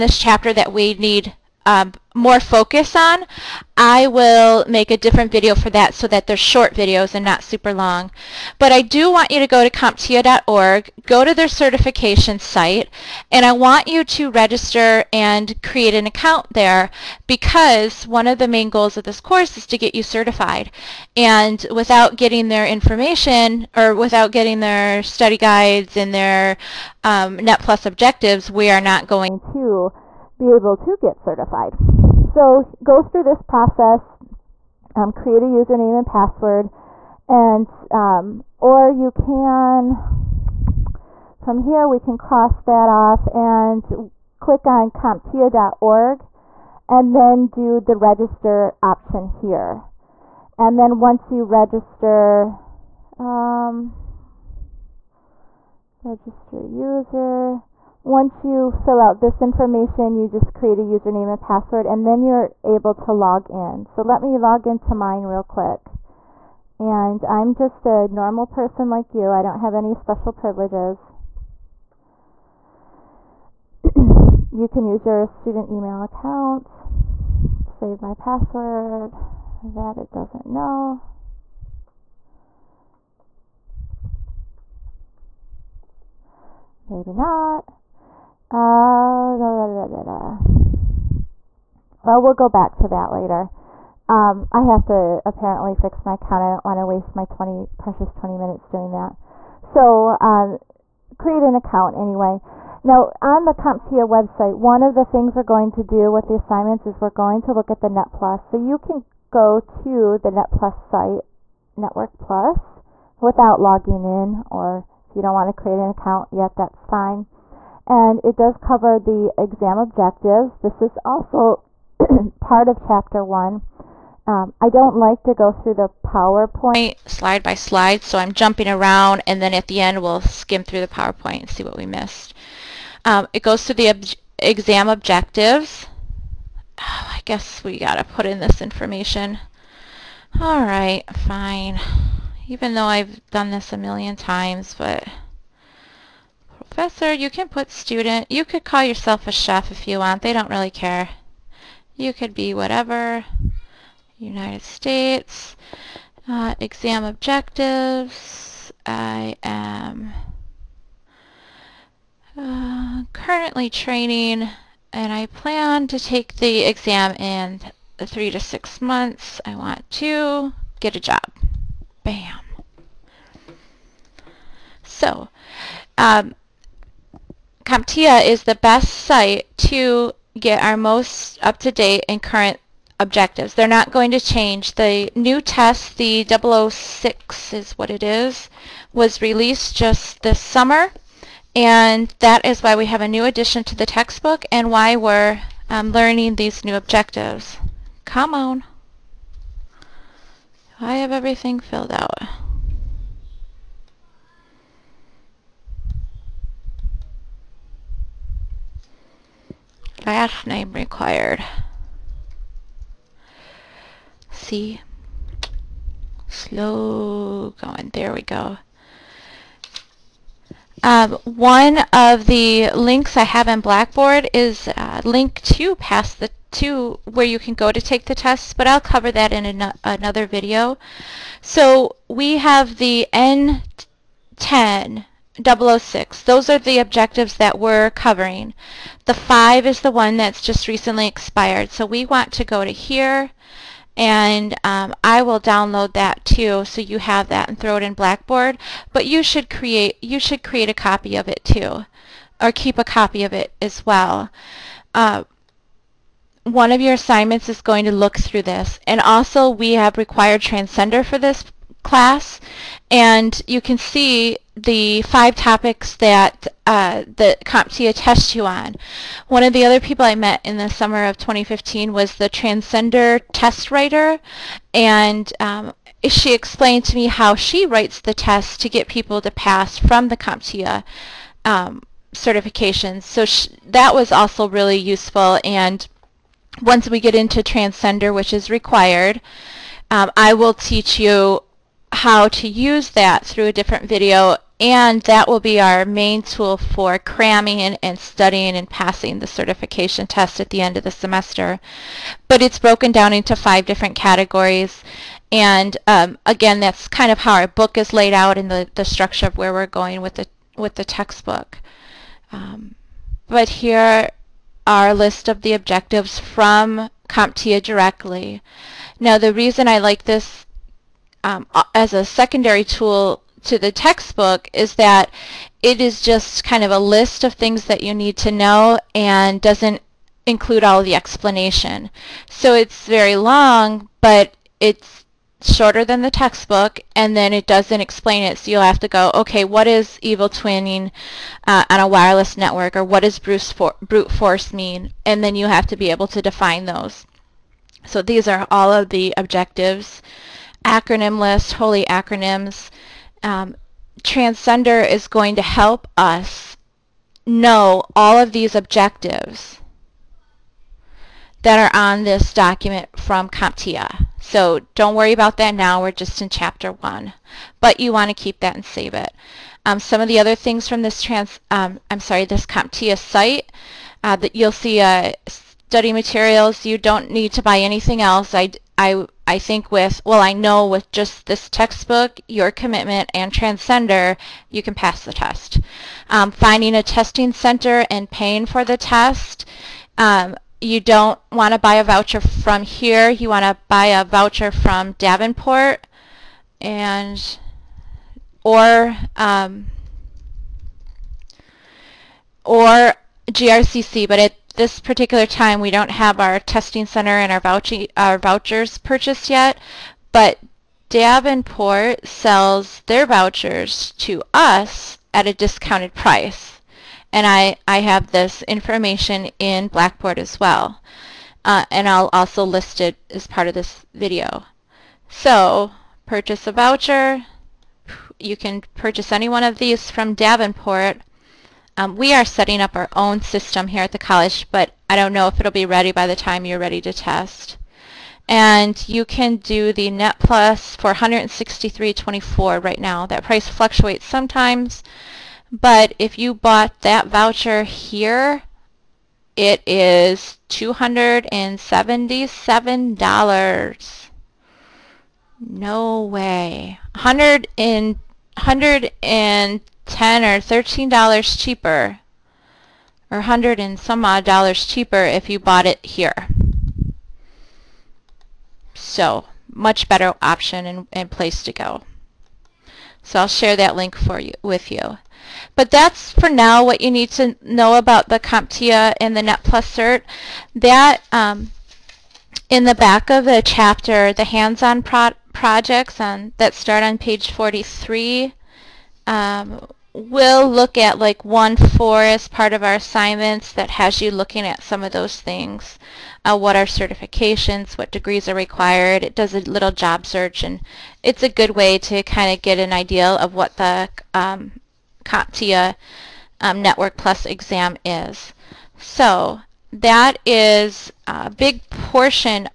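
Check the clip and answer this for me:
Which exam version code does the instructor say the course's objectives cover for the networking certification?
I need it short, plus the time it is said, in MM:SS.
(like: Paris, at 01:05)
N10-006, at 03:53.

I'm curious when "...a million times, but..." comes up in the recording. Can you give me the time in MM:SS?
02:23.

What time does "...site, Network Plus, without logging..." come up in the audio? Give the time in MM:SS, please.
01:50.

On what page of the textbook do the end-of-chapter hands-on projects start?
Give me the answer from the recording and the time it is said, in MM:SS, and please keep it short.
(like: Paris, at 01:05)
Page 43, at 08:06.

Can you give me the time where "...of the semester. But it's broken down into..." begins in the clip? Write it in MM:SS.
05:00.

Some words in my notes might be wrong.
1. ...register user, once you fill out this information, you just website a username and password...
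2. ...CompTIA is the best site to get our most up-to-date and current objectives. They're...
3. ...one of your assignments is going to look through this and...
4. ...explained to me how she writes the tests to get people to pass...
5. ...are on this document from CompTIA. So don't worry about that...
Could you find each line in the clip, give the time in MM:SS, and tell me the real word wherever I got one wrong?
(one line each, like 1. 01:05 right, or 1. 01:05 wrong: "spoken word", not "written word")
1. 00:56 wrong: "create", not "website"
2. 02:57 right
3. 04:16 right
4. 04:36 right
5. 06:01 right.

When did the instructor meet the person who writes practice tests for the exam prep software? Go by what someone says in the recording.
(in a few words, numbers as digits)
Summer of 2015.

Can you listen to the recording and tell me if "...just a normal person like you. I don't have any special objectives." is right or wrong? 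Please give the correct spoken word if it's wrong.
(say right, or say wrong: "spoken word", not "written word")
wrong: "privileges", not "objectives".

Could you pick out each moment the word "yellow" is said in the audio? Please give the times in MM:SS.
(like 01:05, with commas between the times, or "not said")
not said.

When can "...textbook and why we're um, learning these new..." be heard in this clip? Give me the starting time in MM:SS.
03:13.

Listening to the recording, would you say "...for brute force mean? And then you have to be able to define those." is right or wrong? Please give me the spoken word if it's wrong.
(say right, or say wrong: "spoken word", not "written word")
right.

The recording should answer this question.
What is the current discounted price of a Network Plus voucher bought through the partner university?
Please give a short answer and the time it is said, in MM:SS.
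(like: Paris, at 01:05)
$163.24, at 07:20.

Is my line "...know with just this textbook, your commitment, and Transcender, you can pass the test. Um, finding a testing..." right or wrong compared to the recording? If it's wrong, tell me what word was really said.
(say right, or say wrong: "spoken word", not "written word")
right.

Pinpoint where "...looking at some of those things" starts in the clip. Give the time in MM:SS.
08:14.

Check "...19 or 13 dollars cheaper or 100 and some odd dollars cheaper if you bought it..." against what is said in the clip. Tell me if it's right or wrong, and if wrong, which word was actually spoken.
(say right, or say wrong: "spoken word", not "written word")
wrong: "10", not "19".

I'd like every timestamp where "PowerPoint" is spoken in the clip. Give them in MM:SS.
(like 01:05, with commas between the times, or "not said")
02:06, 02:10.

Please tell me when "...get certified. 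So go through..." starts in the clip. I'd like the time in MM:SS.
00:30.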